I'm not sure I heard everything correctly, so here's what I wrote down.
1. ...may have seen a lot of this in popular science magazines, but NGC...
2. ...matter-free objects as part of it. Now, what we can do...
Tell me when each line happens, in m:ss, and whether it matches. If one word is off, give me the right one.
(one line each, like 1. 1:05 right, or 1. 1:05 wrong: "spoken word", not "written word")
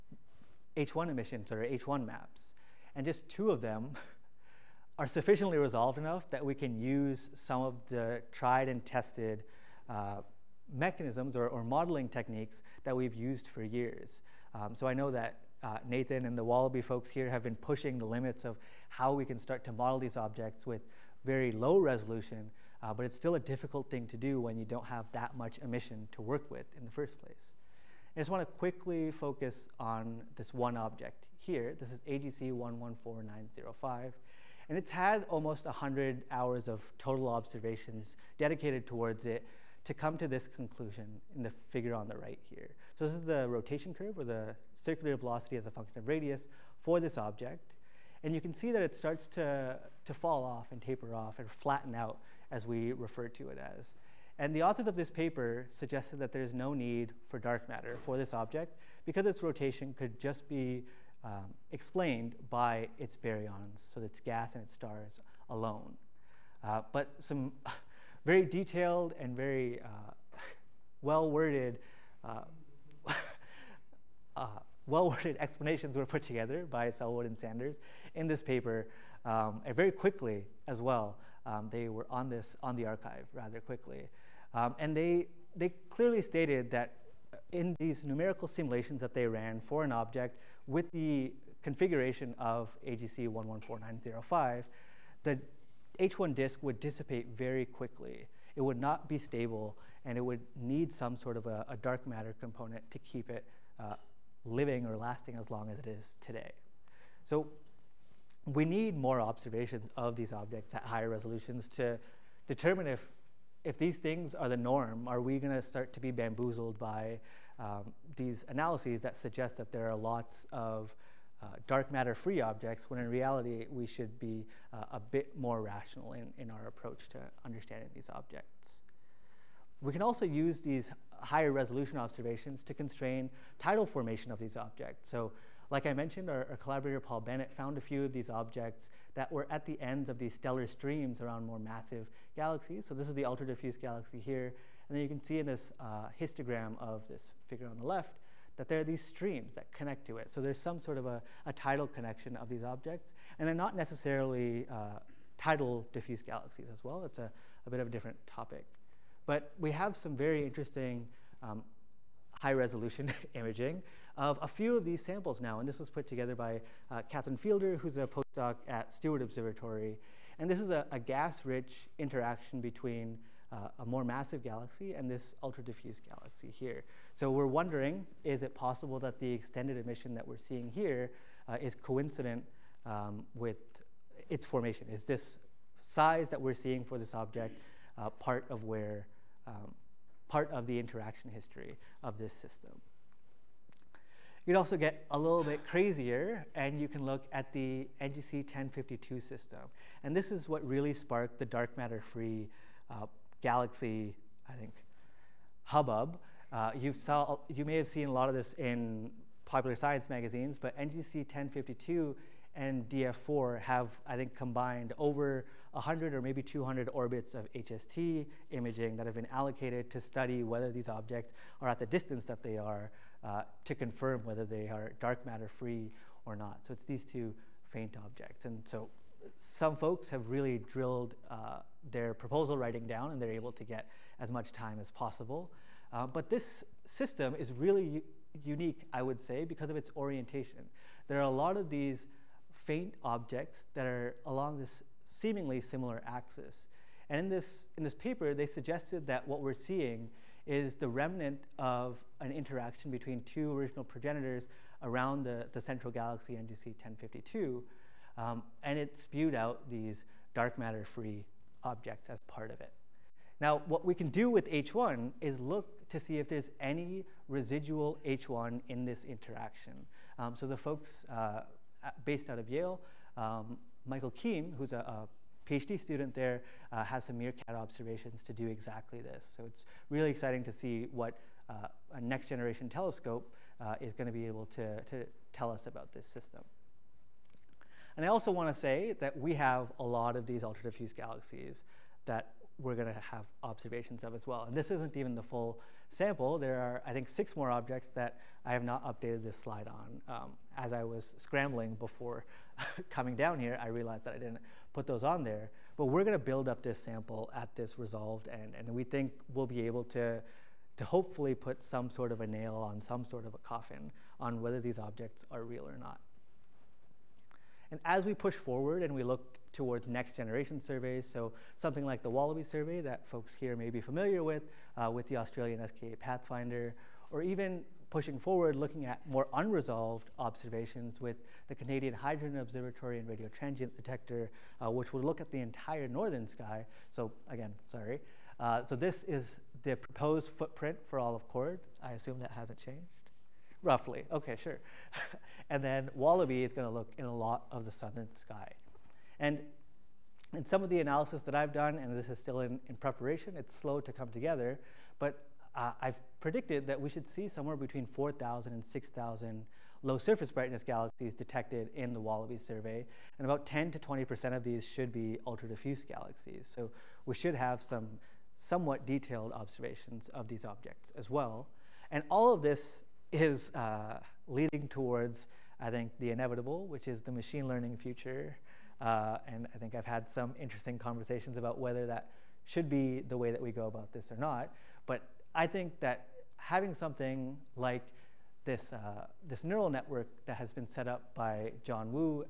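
1. 3:27 right
2. 4:20 right.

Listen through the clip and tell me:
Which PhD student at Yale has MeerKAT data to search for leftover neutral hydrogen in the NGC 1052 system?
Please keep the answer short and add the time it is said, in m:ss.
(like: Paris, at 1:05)
Michael Keim, at 4:33.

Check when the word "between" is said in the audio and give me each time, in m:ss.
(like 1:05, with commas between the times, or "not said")
2:52, 4:12, 5:57.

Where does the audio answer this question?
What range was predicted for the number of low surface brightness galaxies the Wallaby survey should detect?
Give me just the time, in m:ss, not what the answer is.
5:57.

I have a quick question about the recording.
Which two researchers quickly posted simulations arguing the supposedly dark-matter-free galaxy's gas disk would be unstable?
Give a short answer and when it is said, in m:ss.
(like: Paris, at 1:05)
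Sellwood and Sanders, at 1:16.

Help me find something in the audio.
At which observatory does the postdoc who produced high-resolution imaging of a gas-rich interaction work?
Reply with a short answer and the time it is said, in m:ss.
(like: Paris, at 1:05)
Steward Observatory, at 2:48.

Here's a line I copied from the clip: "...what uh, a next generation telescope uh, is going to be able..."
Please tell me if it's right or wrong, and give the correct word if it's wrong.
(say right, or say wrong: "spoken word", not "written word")
right.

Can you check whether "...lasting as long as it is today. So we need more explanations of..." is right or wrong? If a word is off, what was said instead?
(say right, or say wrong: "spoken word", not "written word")
wrong: "observations", not "explanations".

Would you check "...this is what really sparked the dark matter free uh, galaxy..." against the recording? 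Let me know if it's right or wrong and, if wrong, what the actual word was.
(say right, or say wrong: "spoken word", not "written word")
right.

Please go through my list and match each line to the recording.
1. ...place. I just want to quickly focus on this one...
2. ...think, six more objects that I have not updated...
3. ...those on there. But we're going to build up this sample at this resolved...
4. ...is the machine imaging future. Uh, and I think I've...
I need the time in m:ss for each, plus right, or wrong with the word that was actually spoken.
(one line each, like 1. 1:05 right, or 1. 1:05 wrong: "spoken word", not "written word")
1. 0:27 right
2. 4:56 right
3. 5:04 right
4. 6:16 wrong: "learning", not "imaging".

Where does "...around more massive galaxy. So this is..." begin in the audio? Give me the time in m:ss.
2:21.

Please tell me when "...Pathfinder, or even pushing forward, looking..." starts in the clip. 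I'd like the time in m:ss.
5:25.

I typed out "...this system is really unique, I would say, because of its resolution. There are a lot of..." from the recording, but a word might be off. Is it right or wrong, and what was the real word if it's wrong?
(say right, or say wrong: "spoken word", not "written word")
wrong: "orientation", not "resolution".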